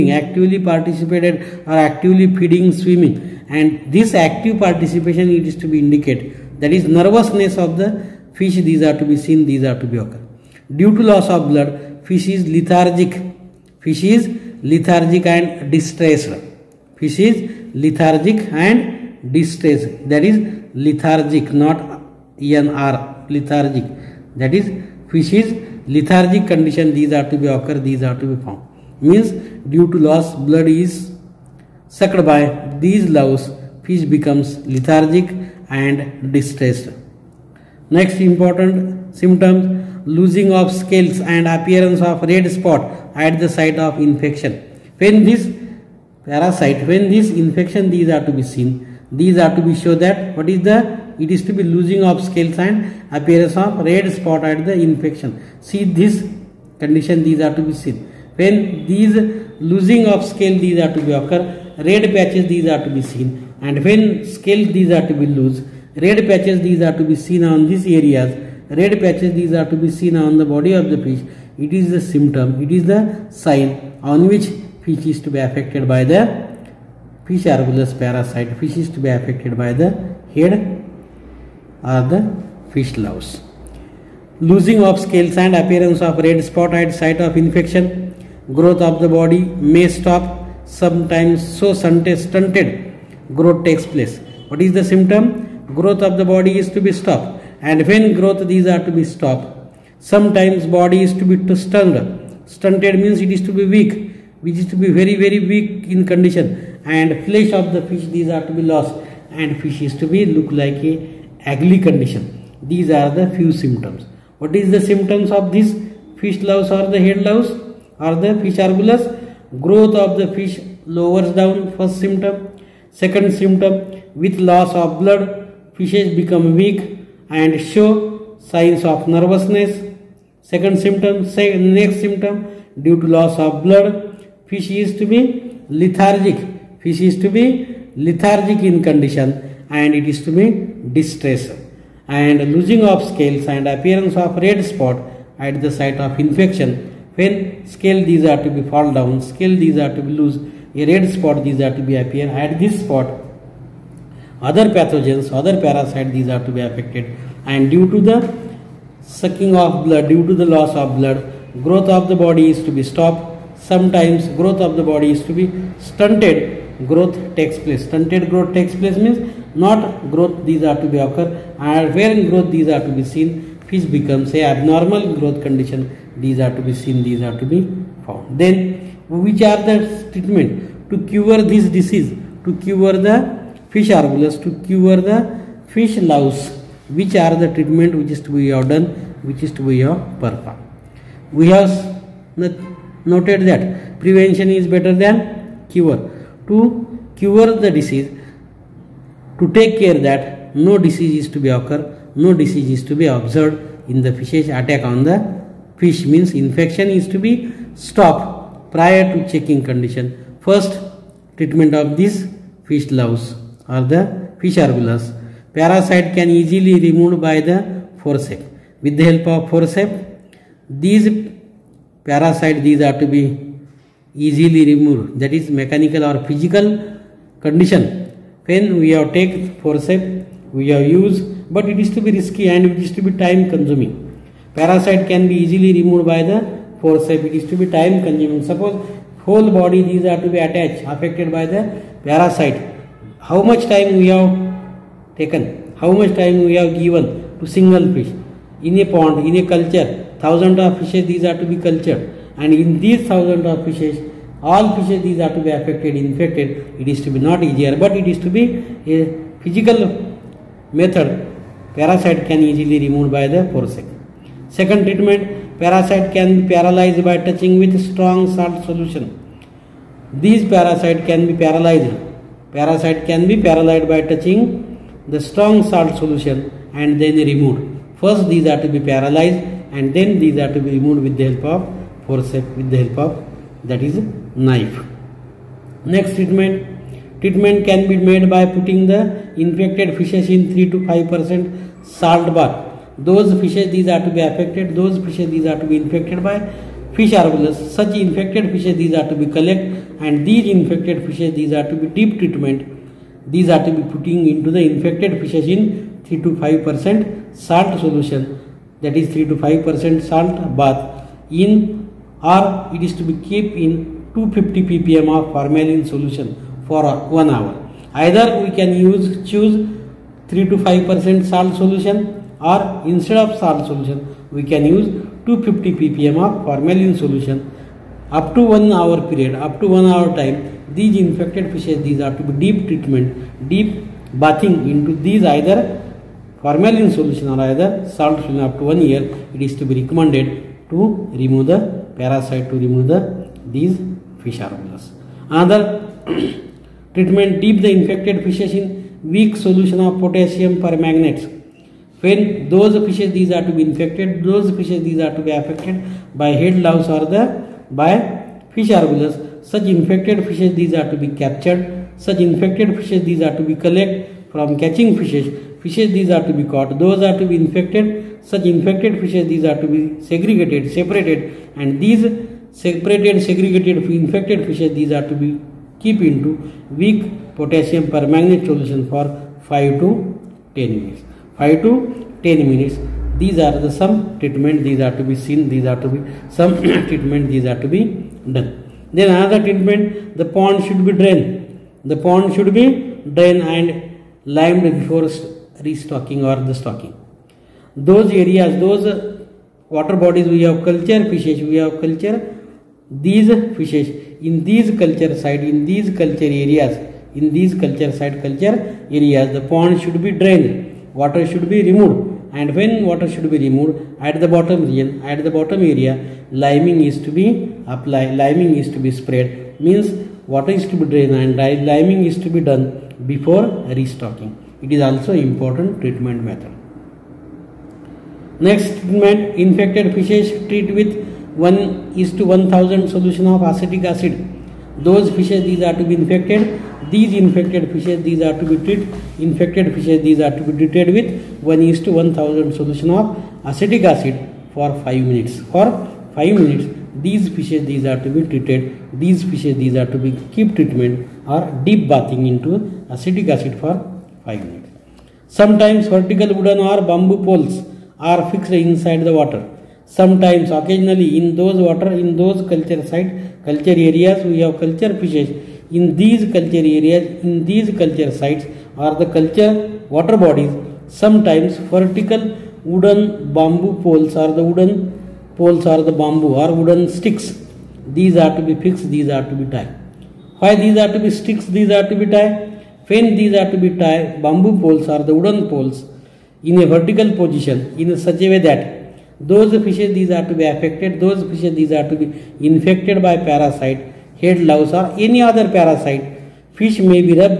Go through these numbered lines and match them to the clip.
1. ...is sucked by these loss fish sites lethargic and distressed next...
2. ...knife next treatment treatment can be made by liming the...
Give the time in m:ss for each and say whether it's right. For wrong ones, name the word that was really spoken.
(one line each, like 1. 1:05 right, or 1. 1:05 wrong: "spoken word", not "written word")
1. 0:30 wrong: "becomes", not "sites"
2. 4:44 wrong: "putting", not "liming".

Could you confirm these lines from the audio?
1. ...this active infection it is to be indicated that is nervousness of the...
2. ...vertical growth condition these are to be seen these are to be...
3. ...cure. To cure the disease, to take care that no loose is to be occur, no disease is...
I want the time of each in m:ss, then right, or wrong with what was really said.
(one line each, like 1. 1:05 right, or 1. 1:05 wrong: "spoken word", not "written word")
1. 0:03 wrong: "participation", not "infection"
2. 2:54 wrong: "abnormal", not "vertical"
3. 3:15 wrong: "disease", not "loose".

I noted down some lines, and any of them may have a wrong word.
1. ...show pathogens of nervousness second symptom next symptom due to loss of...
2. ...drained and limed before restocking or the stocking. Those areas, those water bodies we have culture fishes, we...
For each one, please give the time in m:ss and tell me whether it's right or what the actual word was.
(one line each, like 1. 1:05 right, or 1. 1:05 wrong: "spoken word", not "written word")
1. 2:07 wrong: "signs", not "pathogens"
2. 6:33 right.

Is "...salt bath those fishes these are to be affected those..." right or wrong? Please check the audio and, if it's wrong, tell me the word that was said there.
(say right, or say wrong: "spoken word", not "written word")
right.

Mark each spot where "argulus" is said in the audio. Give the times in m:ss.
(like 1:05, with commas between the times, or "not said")
1:17, 1:58, 3:03, 3:34, 4:57.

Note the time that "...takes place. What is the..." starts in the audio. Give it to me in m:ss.
1:33.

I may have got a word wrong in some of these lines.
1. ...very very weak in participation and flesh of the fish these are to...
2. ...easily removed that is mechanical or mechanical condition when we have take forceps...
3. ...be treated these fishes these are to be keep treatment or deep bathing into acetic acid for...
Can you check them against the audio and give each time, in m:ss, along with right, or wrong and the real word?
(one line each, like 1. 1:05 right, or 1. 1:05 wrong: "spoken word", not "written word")
1. 1:44 wrong: "condition", not "participation"
2. 3:44 wrong: "physical", not "mechanical"
3. 7:28 right.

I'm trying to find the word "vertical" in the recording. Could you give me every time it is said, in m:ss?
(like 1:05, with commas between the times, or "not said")
7:35, 7:51, 8:06.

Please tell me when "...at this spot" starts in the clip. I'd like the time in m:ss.
2:32.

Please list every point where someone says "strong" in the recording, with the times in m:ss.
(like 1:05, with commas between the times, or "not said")
4:27, 4:35.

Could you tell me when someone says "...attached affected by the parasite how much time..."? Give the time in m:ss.
4:00.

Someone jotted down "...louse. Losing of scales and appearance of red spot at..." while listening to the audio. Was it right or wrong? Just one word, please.
right.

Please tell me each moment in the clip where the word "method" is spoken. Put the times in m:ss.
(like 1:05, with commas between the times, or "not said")
4:20, 7:06.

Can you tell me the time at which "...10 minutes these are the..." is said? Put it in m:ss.
6:22.